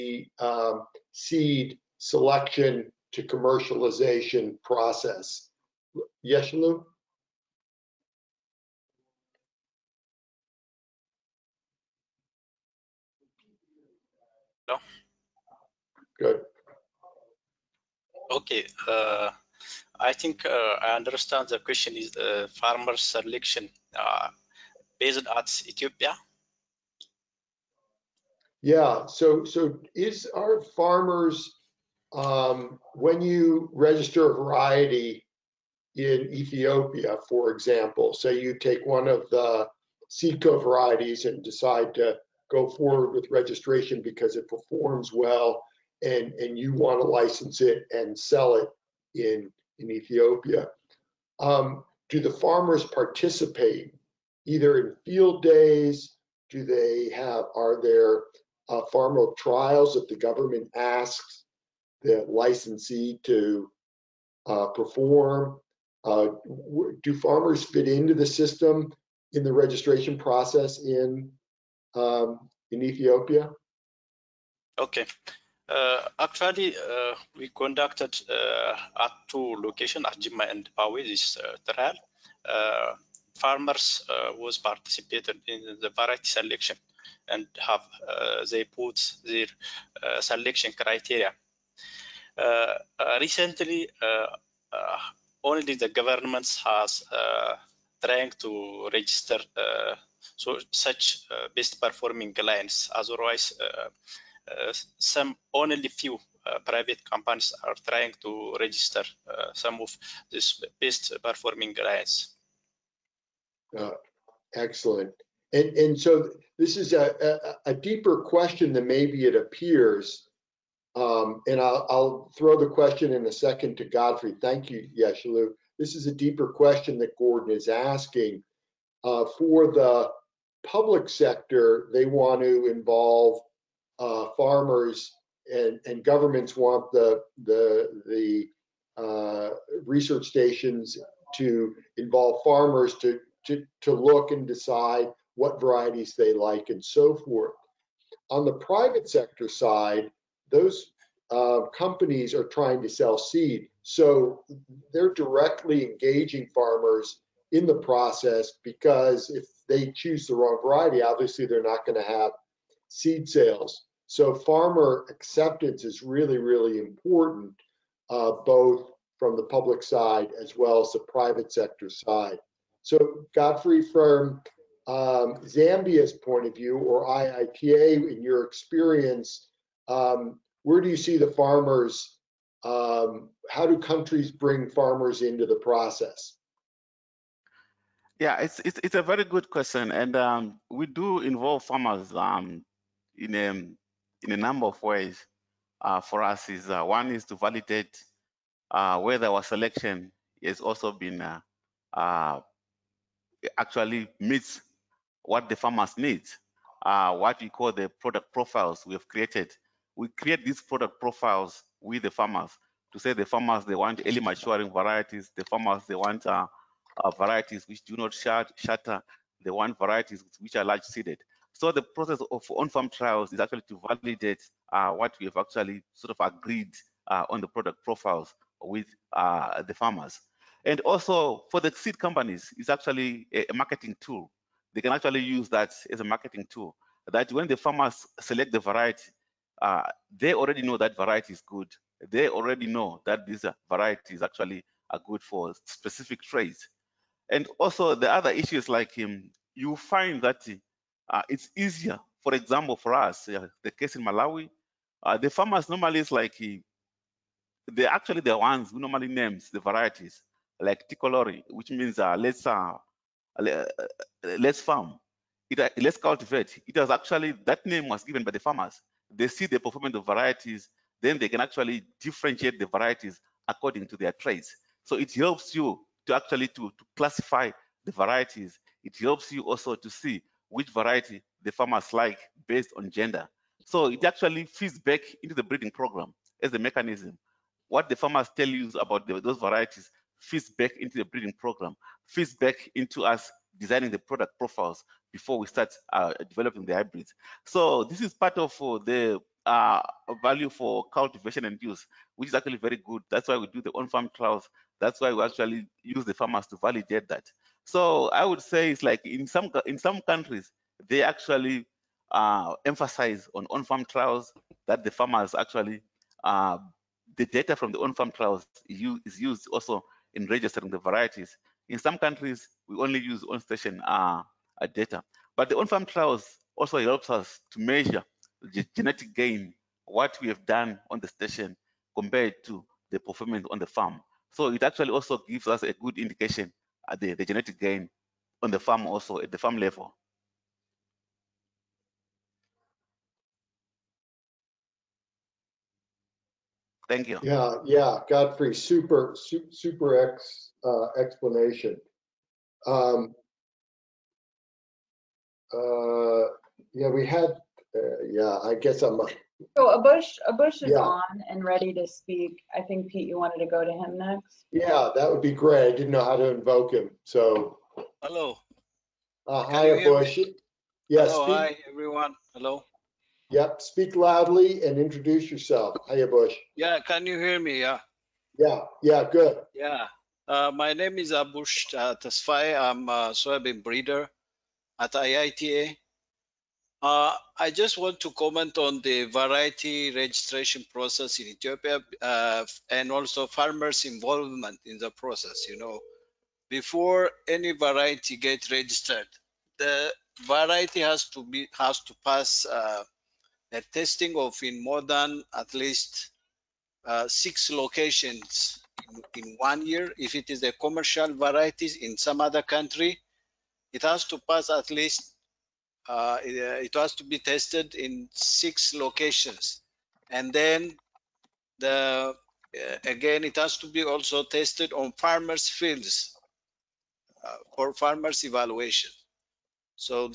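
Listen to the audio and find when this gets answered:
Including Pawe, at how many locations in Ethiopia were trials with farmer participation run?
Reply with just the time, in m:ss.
1:19.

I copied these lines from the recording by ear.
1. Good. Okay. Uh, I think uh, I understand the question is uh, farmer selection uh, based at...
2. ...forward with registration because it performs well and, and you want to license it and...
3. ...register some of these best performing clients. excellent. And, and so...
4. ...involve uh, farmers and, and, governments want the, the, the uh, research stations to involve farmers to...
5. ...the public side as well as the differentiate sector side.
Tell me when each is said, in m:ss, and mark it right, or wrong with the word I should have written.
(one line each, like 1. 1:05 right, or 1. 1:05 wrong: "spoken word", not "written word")
1. 0:16 right
2. 0:42 right
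3. 1:48 right
4. 2:12 right
5. 2:49 wrong: "private", not "differentiate".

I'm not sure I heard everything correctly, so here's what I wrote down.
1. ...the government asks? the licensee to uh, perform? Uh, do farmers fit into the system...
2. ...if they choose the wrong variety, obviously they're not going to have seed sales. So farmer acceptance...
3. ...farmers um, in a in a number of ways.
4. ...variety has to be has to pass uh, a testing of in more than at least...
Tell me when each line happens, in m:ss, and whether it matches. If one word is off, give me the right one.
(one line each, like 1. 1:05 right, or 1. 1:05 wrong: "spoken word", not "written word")
1. 1:00 right
2. 2:39 right
3. 3:11 right
4. 6:40 right.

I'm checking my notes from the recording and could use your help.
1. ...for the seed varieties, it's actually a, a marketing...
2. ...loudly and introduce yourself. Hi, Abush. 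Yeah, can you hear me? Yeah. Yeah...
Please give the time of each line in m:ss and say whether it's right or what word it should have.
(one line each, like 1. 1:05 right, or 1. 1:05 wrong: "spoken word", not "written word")
1. 3:51 wrong: "companies", not "varieties"
2. 6:13 right.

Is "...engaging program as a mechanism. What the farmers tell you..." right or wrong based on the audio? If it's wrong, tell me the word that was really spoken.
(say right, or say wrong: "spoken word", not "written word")
wrong: "breeding", not "engaging".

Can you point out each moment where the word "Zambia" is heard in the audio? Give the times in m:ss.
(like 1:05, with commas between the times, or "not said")
2:55.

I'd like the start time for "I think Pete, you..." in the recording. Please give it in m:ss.
6:02.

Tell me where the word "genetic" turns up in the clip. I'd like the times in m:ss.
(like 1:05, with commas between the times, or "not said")
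5:28, 5:37.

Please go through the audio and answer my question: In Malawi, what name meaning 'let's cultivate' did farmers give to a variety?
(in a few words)
Ticolori.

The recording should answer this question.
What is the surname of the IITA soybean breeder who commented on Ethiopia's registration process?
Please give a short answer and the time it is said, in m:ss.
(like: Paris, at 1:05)
Tesfaye, at 6:22.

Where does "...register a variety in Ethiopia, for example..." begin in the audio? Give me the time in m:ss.
0:33.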